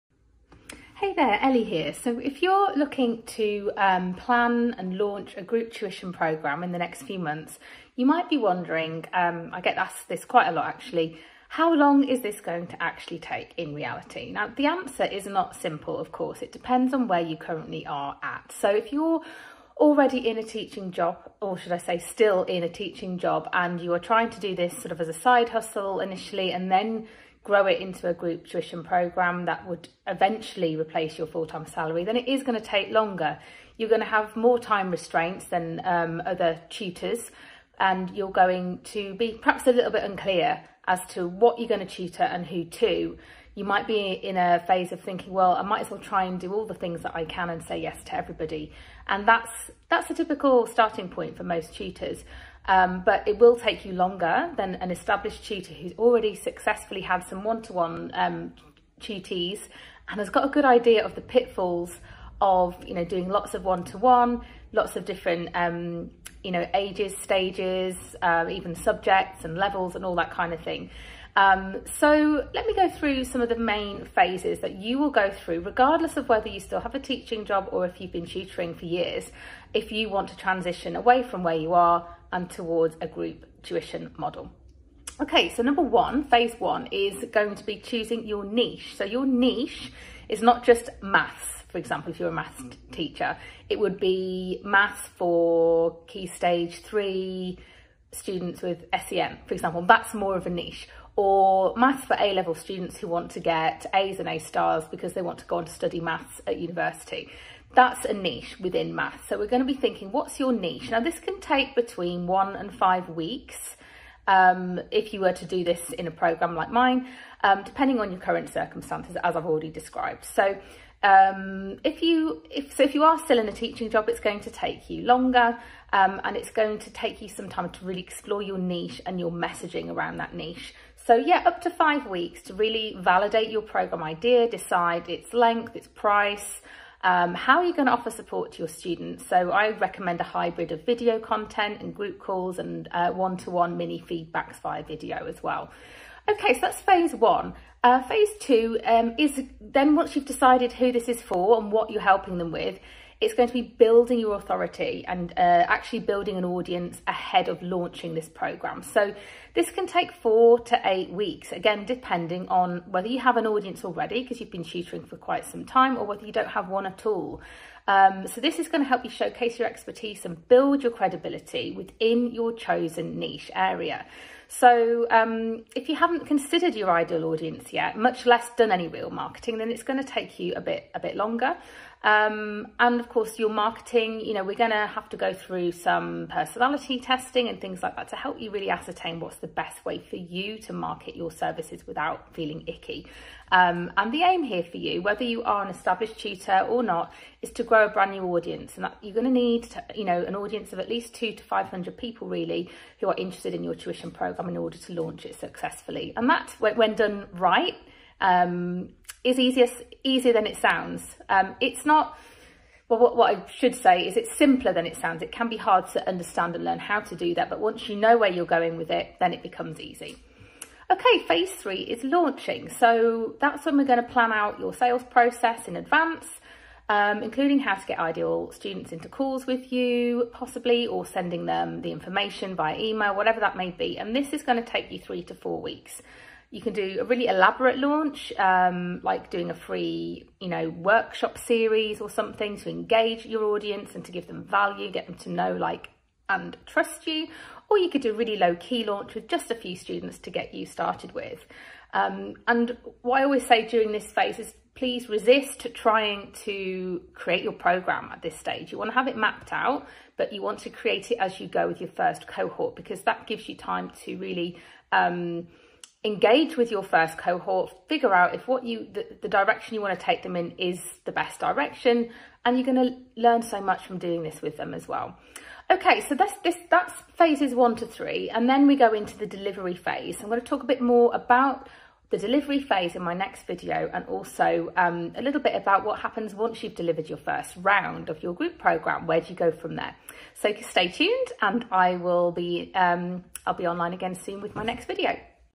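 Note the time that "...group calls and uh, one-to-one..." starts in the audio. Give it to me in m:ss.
2:21.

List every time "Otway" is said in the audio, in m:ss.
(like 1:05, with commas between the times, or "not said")
not said.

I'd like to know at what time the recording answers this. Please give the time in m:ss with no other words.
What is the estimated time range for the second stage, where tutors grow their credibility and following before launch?
2:40.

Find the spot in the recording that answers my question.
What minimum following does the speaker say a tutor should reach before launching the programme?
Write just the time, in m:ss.
3:21.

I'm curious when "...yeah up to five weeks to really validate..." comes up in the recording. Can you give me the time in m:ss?
2:11.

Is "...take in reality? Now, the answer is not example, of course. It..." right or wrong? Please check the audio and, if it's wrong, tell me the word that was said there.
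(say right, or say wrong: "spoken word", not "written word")
wrong: "simple", not "example".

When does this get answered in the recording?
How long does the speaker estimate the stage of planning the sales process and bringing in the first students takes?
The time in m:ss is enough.
3:54.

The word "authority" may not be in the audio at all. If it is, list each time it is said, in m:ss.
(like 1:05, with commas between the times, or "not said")
2:34.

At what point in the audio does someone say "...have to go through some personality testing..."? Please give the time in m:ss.
3:04.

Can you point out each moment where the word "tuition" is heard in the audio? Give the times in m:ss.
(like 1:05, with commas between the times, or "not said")
0:05, 0:28, 1:23, 3:23.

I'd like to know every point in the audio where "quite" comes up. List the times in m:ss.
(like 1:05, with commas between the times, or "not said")
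0:10, 2:45.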